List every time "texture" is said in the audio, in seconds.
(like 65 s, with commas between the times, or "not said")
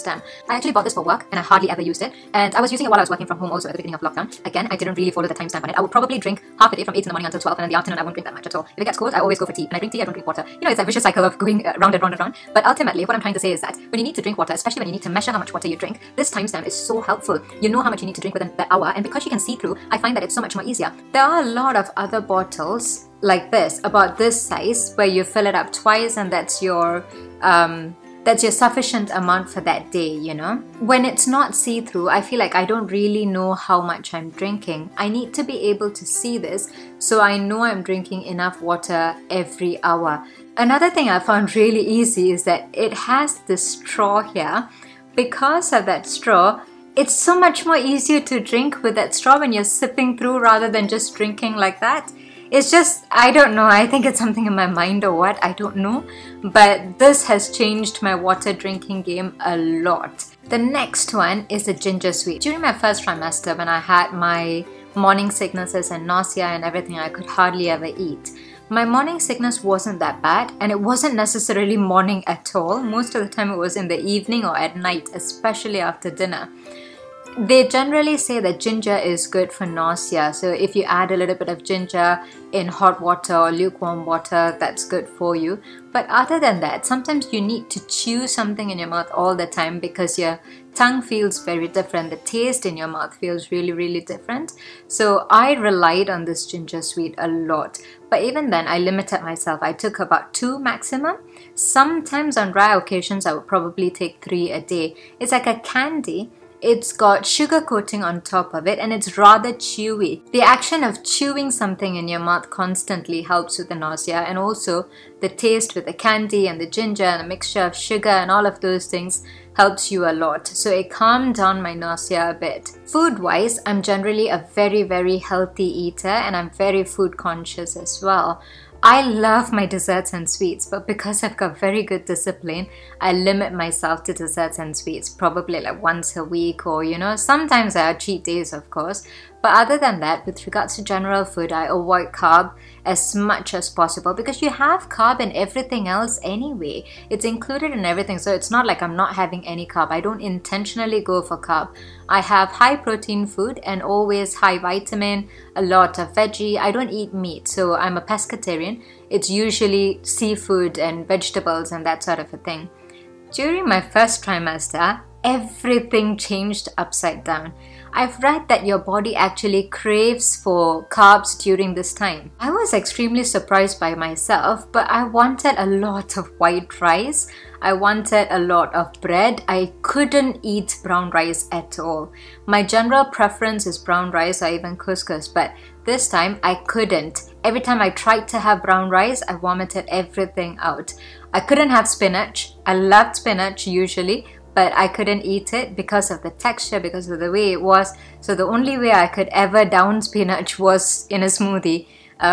196 s.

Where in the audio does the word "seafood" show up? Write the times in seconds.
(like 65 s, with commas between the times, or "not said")
160 s.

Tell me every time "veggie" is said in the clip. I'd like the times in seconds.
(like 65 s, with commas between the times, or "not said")
156 s.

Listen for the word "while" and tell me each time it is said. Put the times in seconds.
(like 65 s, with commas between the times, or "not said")
2 s.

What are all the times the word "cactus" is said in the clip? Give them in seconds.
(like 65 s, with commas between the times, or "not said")
not said.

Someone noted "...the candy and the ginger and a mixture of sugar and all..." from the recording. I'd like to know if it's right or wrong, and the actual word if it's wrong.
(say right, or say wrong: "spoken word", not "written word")
right.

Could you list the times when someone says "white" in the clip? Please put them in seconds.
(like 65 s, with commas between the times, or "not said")
176 s.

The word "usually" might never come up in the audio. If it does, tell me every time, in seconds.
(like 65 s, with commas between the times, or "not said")
159 s, 193 s.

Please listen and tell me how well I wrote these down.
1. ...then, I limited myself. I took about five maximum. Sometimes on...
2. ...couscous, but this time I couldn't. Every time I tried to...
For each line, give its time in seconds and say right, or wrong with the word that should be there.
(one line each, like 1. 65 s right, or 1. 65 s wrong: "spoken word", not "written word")
1. 98 s wrong: "two", not "five"
2. 184 s right.